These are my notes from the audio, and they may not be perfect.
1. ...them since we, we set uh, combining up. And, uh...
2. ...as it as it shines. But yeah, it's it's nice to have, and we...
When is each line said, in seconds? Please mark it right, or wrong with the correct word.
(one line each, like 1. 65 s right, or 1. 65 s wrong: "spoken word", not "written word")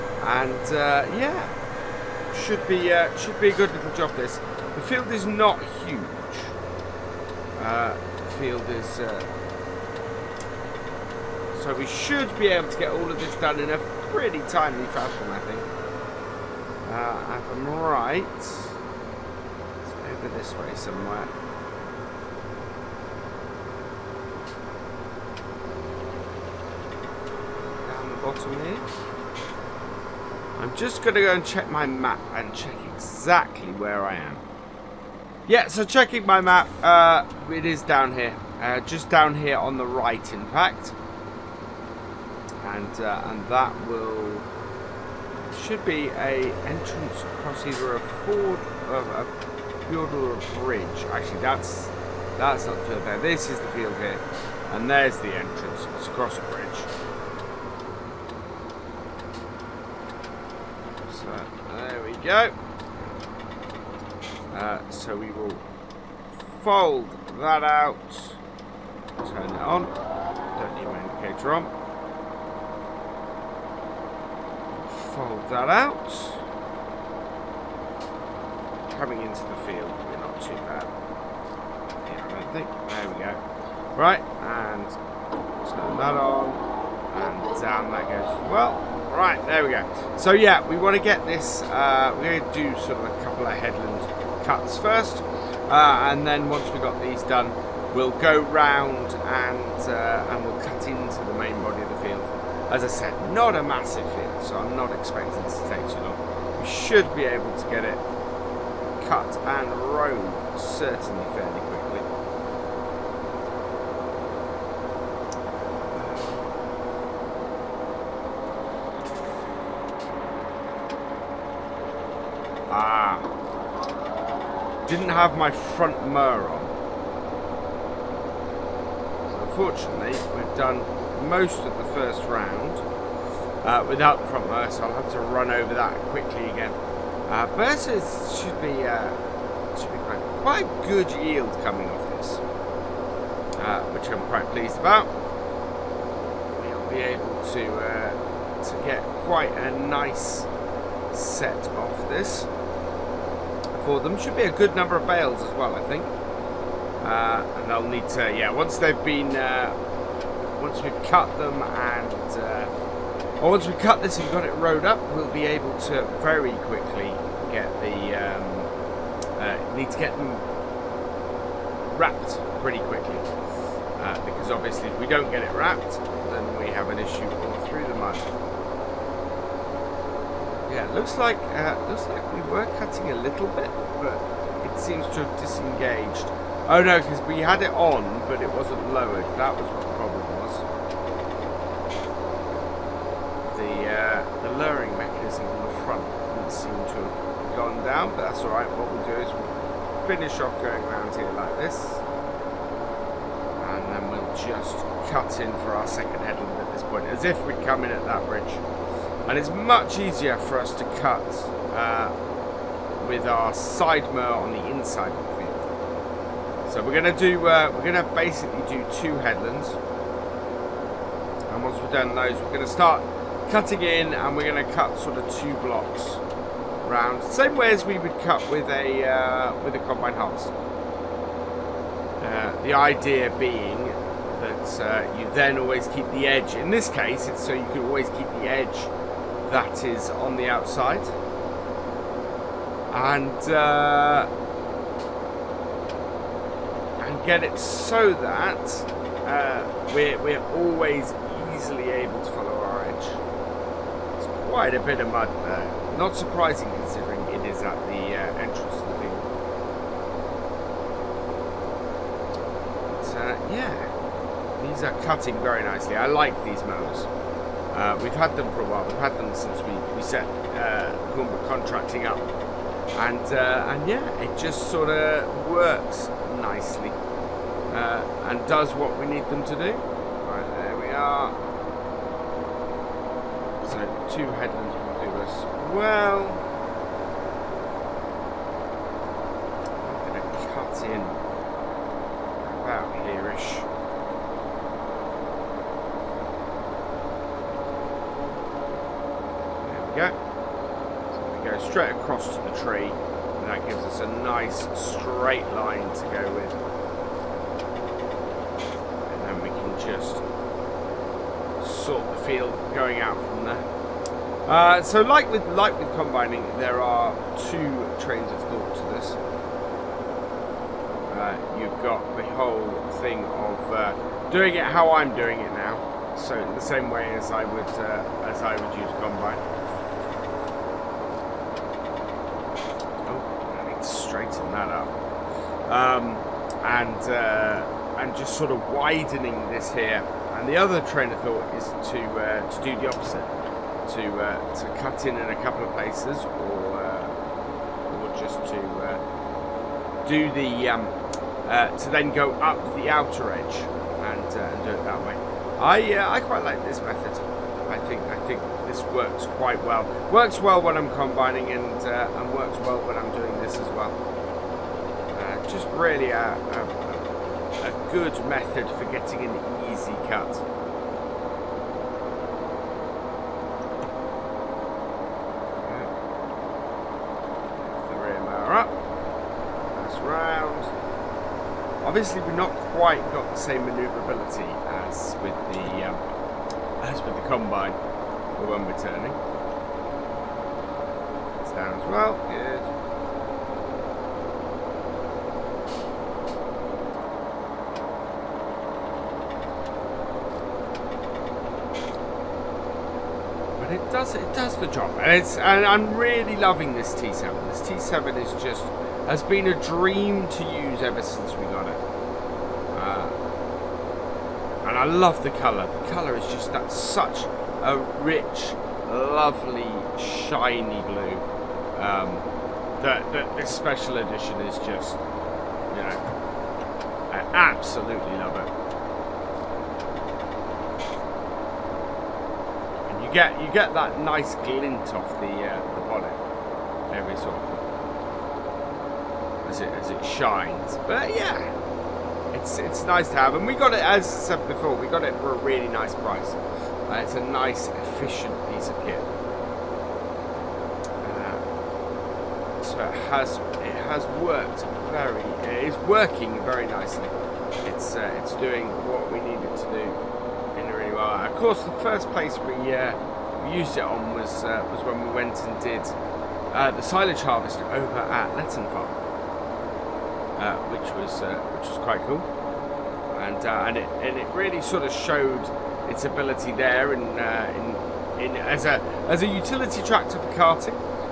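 1. 269 s wrong: "contracting", not "combining"
2. 439 s right.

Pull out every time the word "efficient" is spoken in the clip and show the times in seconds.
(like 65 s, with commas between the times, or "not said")
447 s.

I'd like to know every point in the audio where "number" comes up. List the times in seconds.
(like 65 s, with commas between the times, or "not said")
154 s.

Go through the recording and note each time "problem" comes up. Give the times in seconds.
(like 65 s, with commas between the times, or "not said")
189 s.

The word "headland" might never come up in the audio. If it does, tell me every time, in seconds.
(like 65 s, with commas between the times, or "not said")
93 s, 206 s, 219 s, 284 s.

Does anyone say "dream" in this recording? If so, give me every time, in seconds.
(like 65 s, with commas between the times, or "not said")
409 s.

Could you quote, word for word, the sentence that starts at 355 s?
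I I quite like this method.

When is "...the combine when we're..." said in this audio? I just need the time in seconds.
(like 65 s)
387 s.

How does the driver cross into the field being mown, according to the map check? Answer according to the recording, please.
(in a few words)
Across a bridge.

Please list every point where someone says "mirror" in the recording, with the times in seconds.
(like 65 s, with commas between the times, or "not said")
126 s, 134 s.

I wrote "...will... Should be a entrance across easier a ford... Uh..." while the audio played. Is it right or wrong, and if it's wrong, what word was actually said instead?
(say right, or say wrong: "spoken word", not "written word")
wrong: "either", not "easier".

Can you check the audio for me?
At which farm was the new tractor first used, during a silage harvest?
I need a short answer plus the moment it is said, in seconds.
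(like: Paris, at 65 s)
Letton Farm, at 468 s.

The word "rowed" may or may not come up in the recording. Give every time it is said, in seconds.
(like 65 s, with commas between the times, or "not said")
109 s, 164 s.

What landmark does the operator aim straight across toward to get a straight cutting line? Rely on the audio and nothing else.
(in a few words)
The tree.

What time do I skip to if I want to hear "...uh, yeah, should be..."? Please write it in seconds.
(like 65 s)
0 s.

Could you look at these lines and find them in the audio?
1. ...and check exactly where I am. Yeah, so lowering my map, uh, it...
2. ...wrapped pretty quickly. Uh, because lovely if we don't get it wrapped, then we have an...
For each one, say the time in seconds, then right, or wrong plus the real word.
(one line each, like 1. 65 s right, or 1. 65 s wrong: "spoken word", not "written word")
1. 32 s wrong: "checking", not "lowering"
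2. 171 s wrong: "obviously", not "lovely".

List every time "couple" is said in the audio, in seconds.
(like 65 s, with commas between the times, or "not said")
93 s, 345 s.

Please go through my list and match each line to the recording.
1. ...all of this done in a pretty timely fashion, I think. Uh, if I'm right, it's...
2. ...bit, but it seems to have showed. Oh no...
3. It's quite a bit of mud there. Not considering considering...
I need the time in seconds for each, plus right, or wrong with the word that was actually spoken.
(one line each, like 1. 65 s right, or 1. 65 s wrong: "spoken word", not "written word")
1. 12 s right
2. 183 s wrong: "disengaged", not "showed"
3. 254 s wrong: "surprising", not "considering".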